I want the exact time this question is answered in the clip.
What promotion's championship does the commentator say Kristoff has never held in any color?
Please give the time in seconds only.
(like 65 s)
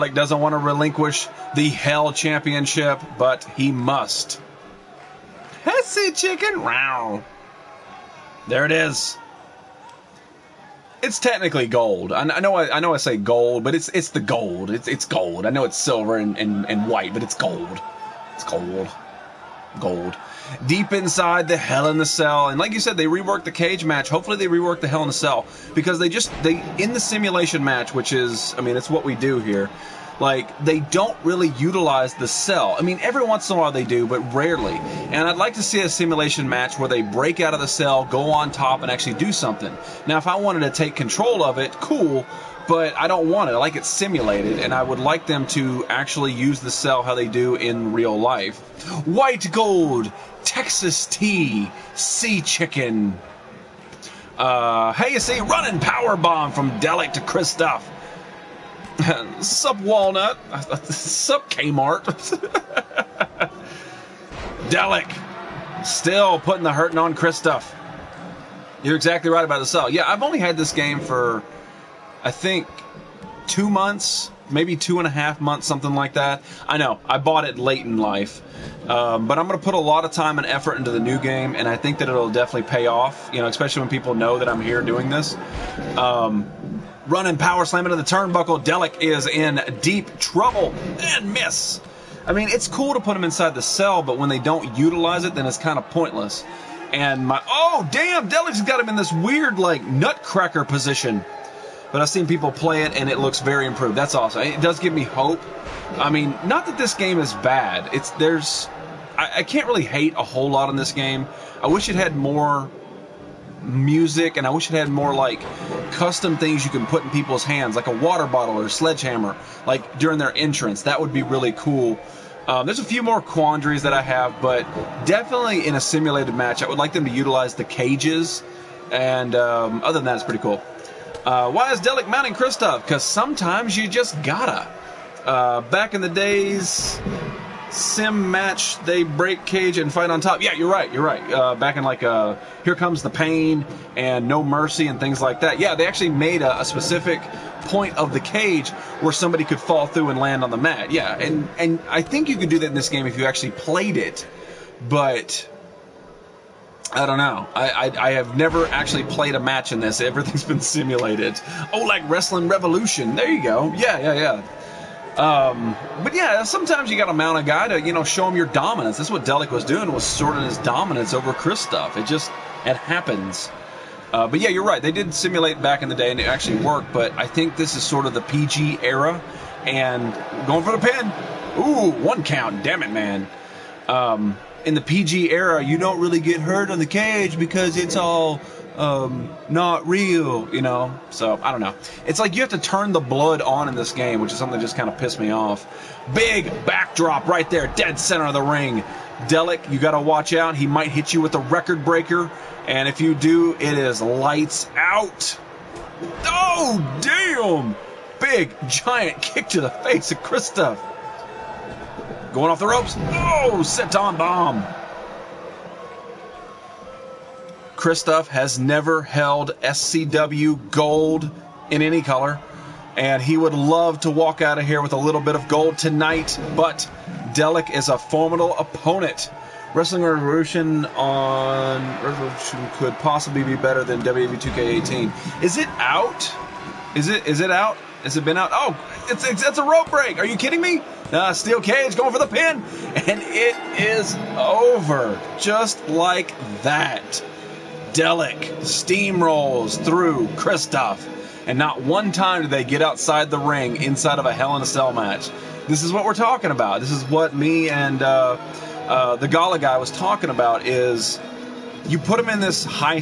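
219 s.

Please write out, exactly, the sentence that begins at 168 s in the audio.
That's what Delic was doing was sorting his dominance over Kristoff.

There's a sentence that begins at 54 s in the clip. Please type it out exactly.
Uh, hey, you see, running power bomb from Delic to Kristoff.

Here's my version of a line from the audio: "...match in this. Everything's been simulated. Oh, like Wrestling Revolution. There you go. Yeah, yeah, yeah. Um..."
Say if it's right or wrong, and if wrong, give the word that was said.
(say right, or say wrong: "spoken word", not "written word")
right.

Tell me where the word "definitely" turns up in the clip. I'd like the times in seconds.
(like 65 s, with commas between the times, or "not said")
82 s, 125 s.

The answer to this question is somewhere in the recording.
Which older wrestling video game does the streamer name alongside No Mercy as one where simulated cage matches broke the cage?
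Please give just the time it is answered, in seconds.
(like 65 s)
142 s.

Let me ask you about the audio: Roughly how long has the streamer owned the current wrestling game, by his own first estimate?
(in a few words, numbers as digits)
2 months.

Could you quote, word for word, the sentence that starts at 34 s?
And I'd like to see a simulation match where they break out of the cell, go on top, and actually do something.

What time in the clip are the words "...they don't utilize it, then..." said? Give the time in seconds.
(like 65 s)
94 s.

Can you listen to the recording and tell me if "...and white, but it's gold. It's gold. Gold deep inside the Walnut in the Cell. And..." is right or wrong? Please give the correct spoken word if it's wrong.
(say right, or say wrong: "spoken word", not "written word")
wrong: "Hell", not "Walnut".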